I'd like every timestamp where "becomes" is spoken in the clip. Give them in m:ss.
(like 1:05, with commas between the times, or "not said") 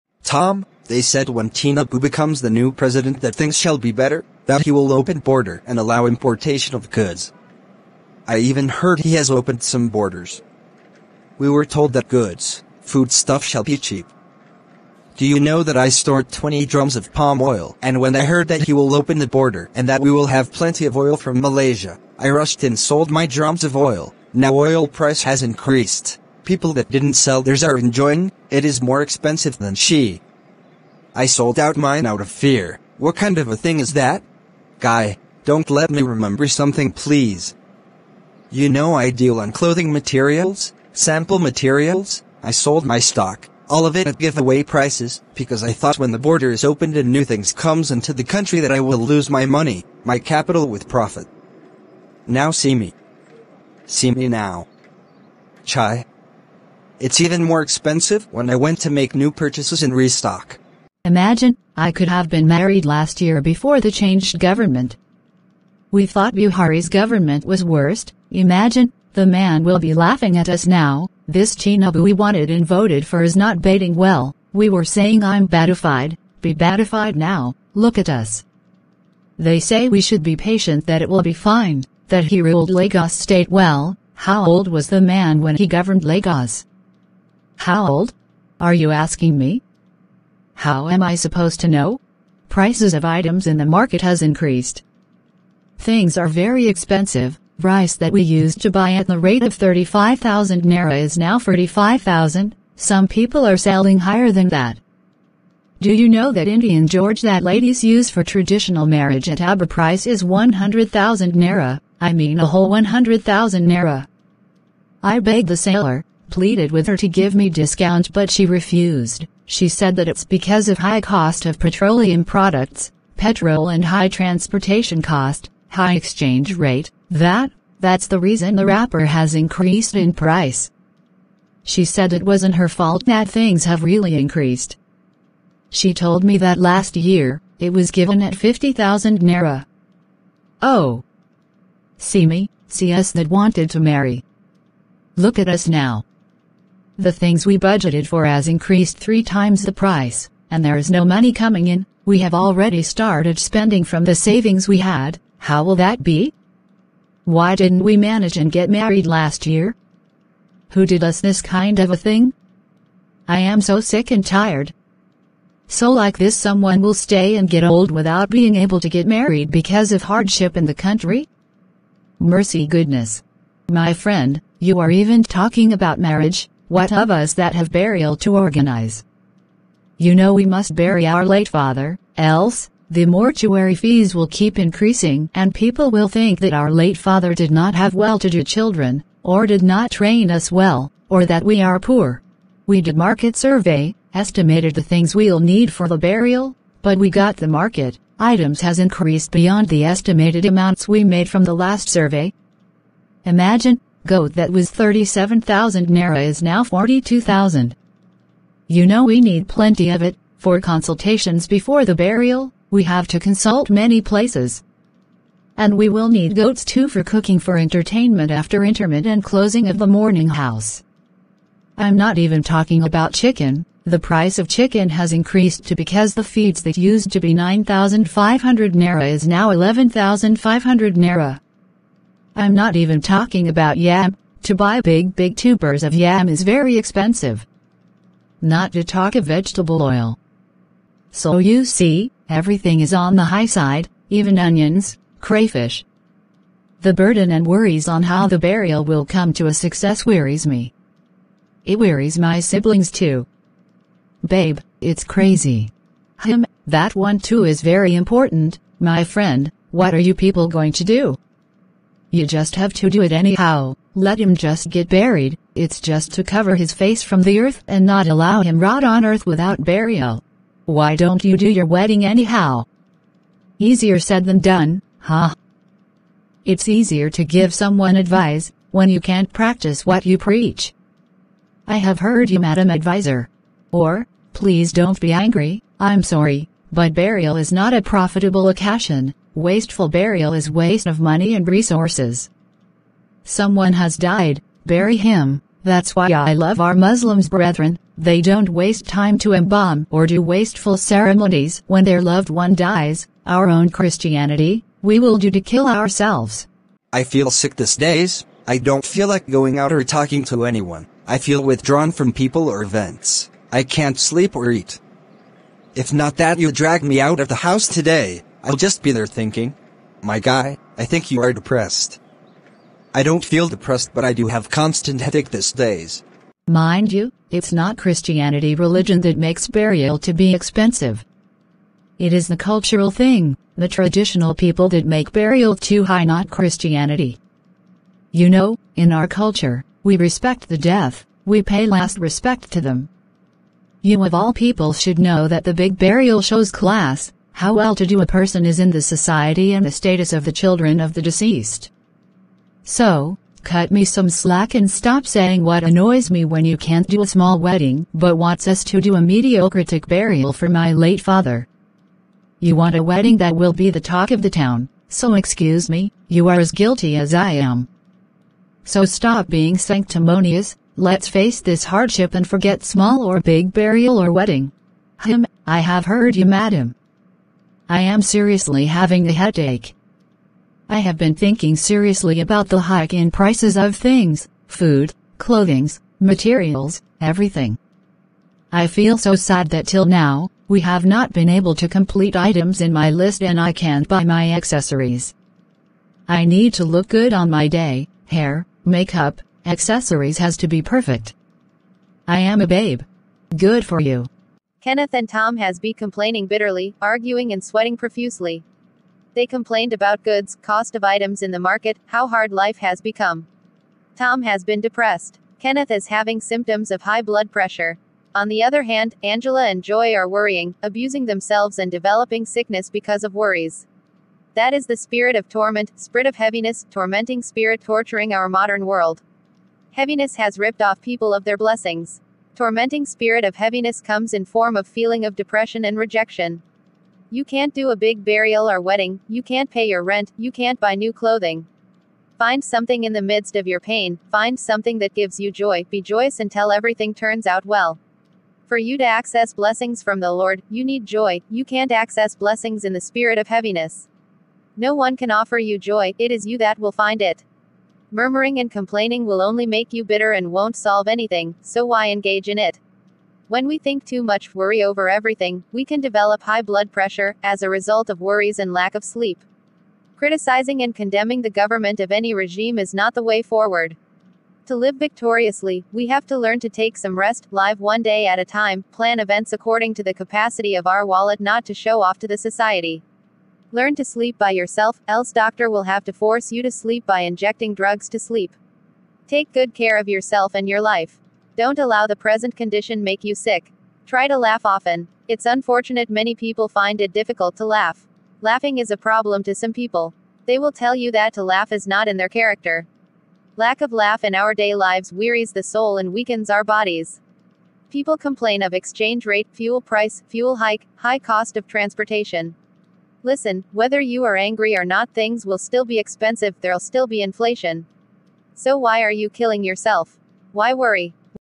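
0:01, 6:52.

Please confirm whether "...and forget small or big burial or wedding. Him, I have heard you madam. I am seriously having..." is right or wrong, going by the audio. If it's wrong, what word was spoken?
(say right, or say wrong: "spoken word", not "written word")
right.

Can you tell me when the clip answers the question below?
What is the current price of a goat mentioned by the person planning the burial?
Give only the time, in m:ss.
3:26.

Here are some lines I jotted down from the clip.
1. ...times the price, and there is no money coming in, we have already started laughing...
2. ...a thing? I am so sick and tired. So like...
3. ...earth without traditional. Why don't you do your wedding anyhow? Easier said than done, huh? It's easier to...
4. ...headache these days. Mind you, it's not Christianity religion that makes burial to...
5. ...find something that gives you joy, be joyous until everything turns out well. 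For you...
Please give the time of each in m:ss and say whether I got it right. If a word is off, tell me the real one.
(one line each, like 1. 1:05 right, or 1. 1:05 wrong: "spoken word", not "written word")
1. 2:29 wrong: "spending", not "laughing"
2. 2:41 right
3. 4:29 wrong: "burial", not "traditional"
4. 5:24 right
5. 7:24 right.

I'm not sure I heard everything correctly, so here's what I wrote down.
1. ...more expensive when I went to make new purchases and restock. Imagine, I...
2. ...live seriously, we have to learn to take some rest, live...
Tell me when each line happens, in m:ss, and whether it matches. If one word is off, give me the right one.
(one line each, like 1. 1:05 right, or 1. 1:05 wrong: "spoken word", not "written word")
1. 0:57 right
2. 7:54 wrong: "victoriously", not "seriously".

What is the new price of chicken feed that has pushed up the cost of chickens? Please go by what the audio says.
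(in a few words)
11,500 naira.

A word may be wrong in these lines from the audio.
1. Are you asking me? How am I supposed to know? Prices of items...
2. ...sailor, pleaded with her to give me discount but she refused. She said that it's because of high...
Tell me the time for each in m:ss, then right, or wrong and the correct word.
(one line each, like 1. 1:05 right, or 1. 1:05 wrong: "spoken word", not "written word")
1. 1:28 right
2. 1:55 right.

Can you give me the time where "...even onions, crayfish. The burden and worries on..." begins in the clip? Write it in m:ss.
4:04.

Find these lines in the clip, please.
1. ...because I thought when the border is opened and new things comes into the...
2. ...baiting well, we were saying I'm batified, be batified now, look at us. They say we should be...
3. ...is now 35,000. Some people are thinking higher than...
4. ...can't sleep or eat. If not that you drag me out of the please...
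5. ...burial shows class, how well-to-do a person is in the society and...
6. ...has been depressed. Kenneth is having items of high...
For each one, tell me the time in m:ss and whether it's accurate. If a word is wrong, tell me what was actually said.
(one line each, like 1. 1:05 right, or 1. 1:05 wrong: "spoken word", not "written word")
1. 0:45 right
2. 1:13 right
3. 1:40 wrong: "selling", not "thinking"
4. 5:13 wrong: "house", not "please"
5. 5:45 right
6. 6:54 wrong: "symptoms", not "items".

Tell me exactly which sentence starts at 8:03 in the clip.
Learn to sleep by yourself, else doctor will have to force you to sleep by injecting drugs to sleep.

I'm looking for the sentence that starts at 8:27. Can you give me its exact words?
People complain of exchange rate, fuel price, fuel hike, high cost of transportation.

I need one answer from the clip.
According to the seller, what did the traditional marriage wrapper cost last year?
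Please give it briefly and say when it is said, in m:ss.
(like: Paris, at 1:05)
50,000 naira, at 2:18.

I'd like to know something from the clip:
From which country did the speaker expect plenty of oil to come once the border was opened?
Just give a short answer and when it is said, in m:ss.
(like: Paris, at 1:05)
Malaysia, at 0:21.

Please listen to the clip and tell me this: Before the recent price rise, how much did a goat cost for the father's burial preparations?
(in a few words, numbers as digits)
37,000 naira.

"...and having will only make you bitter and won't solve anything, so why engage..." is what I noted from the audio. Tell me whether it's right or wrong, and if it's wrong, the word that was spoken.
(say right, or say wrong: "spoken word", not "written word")
wrong: "complaining", not "having".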